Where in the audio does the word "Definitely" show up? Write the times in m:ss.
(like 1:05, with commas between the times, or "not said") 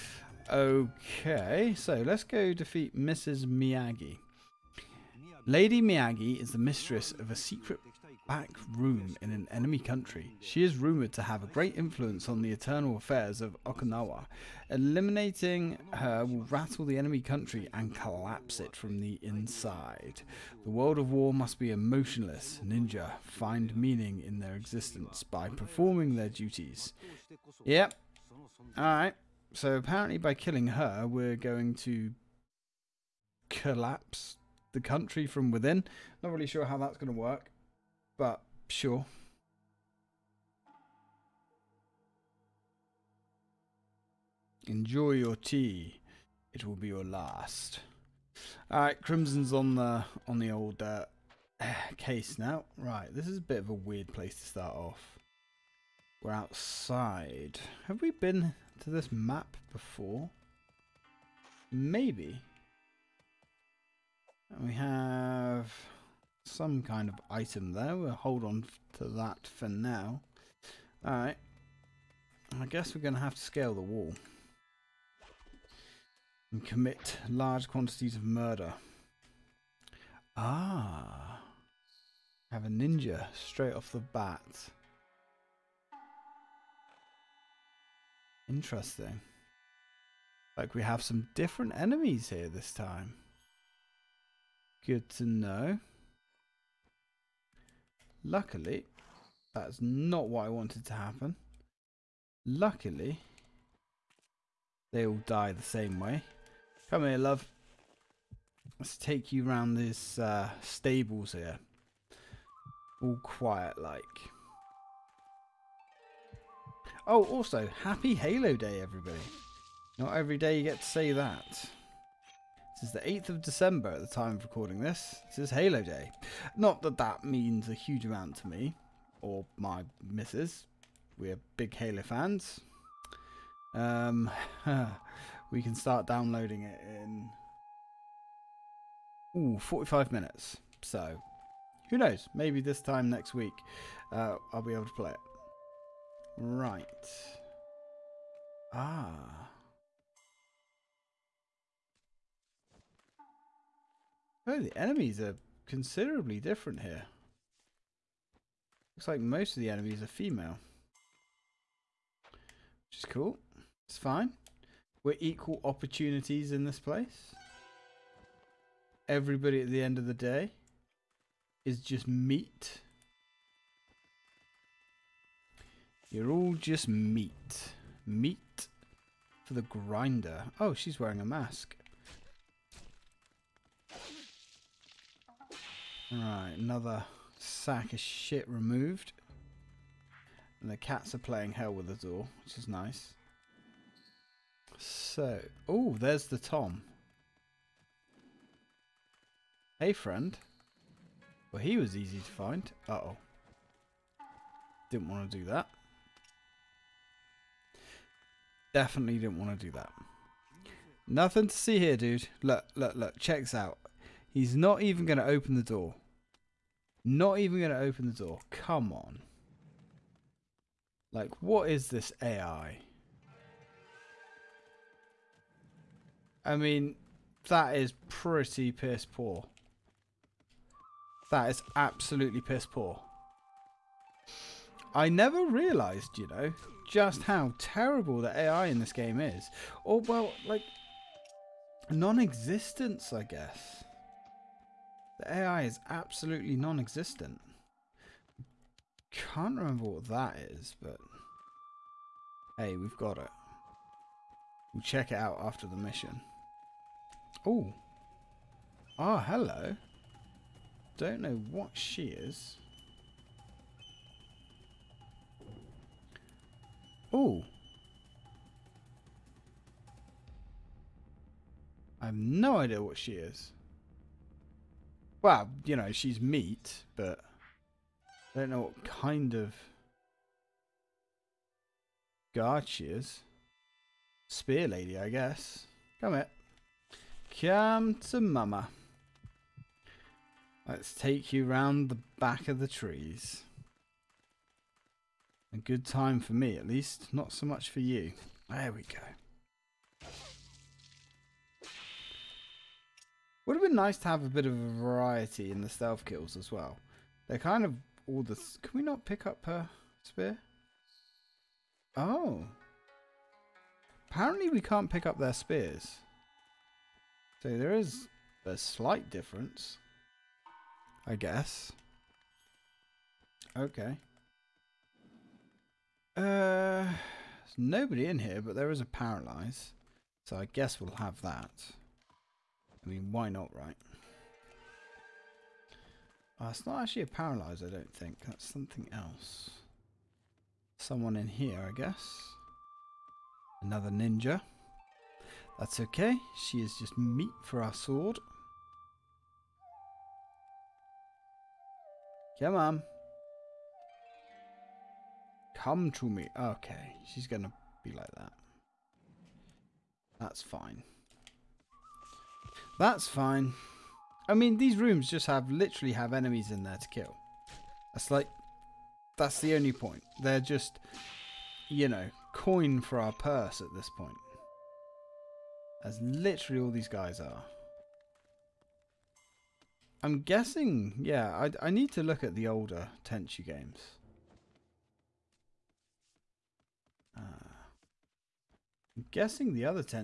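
3:28.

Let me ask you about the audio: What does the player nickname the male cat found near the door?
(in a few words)
the Tom.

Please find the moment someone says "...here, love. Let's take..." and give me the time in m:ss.
1:47.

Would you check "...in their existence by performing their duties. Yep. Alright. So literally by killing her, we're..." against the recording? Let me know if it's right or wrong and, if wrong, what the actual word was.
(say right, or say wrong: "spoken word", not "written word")
wrong: "apparently", not "literally".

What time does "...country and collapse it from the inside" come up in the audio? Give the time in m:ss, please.
0:17.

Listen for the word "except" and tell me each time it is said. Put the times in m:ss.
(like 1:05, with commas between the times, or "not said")
not said.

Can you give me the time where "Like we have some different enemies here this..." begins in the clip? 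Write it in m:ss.
1:30.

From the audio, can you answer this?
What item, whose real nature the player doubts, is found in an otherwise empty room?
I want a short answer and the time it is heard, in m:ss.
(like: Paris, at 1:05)
a paralyze, at 5:28.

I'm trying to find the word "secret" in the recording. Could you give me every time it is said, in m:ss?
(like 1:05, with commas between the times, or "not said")
0:07.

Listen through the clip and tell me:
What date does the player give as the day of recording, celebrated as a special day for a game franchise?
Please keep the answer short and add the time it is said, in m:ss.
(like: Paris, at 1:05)
8th of December, at 2:03.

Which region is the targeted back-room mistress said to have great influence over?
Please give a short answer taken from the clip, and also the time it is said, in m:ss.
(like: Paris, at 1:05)
Okinawa, at 0:13.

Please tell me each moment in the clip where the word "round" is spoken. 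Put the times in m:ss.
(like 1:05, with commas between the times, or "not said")
1:49, 4:51.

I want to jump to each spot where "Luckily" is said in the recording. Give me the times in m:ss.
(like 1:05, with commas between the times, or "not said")
1:38, 1:42.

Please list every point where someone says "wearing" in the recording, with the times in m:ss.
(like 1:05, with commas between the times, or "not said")
3:00.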